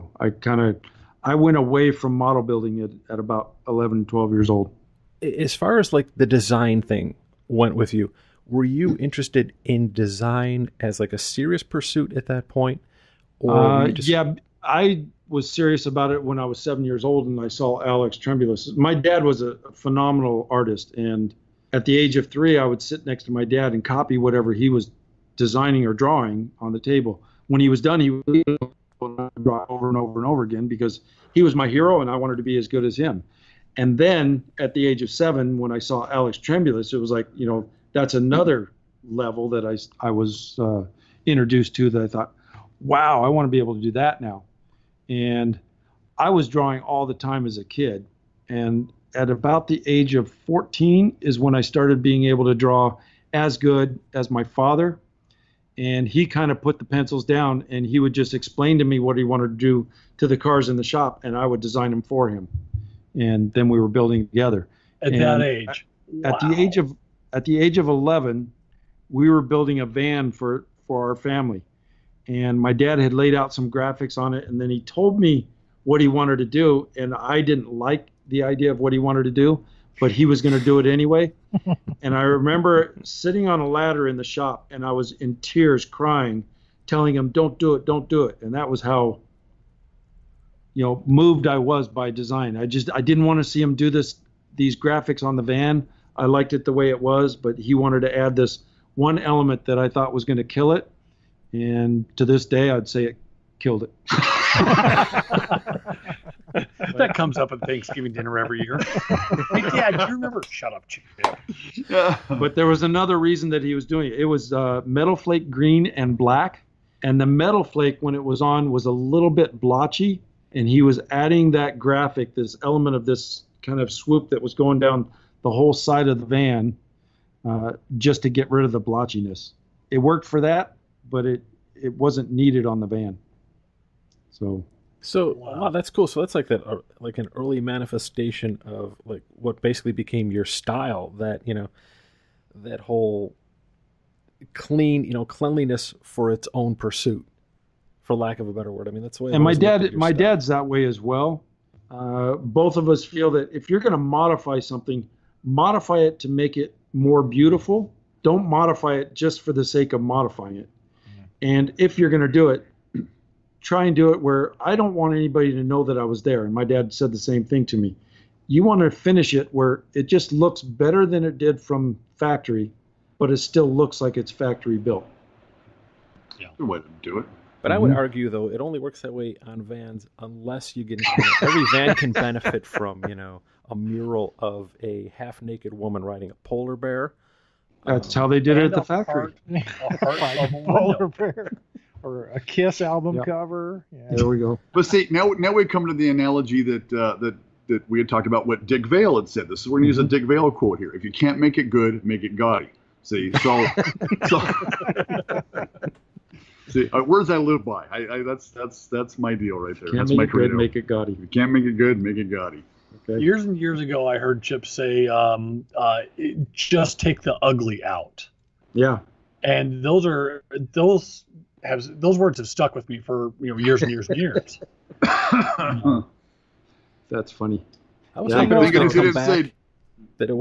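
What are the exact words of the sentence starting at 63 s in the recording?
And then we were building together.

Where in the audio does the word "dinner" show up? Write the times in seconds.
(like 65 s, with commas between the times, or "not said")
108 s.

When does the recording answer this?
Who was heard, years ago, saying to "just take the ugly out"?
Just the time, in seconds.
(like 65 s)
214 s.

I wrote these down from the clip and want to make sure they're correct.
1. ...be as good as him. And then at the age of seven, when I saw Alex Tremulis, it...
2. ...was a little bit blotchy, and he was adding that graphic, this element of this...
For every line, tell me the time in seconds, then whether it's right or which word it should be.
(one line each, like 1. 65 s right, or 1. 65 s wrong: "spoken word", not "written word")
1. 32 s right
2. 118 s right.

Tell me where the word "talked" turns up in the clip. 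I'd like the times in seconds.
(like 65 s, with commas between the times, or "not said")
198 s.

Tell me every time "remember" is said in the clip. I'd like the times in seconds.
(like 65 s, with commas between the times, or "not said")
82 s, 110 s.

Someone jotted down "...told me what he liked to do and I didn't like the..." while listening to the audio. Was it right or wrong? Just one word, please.
wrong.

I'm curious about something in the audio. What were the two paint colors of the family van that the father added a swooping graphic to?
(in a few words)
Metal flake green and black.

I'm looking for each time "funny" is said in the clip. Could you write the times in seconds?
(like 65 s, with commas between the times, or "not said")
227 s.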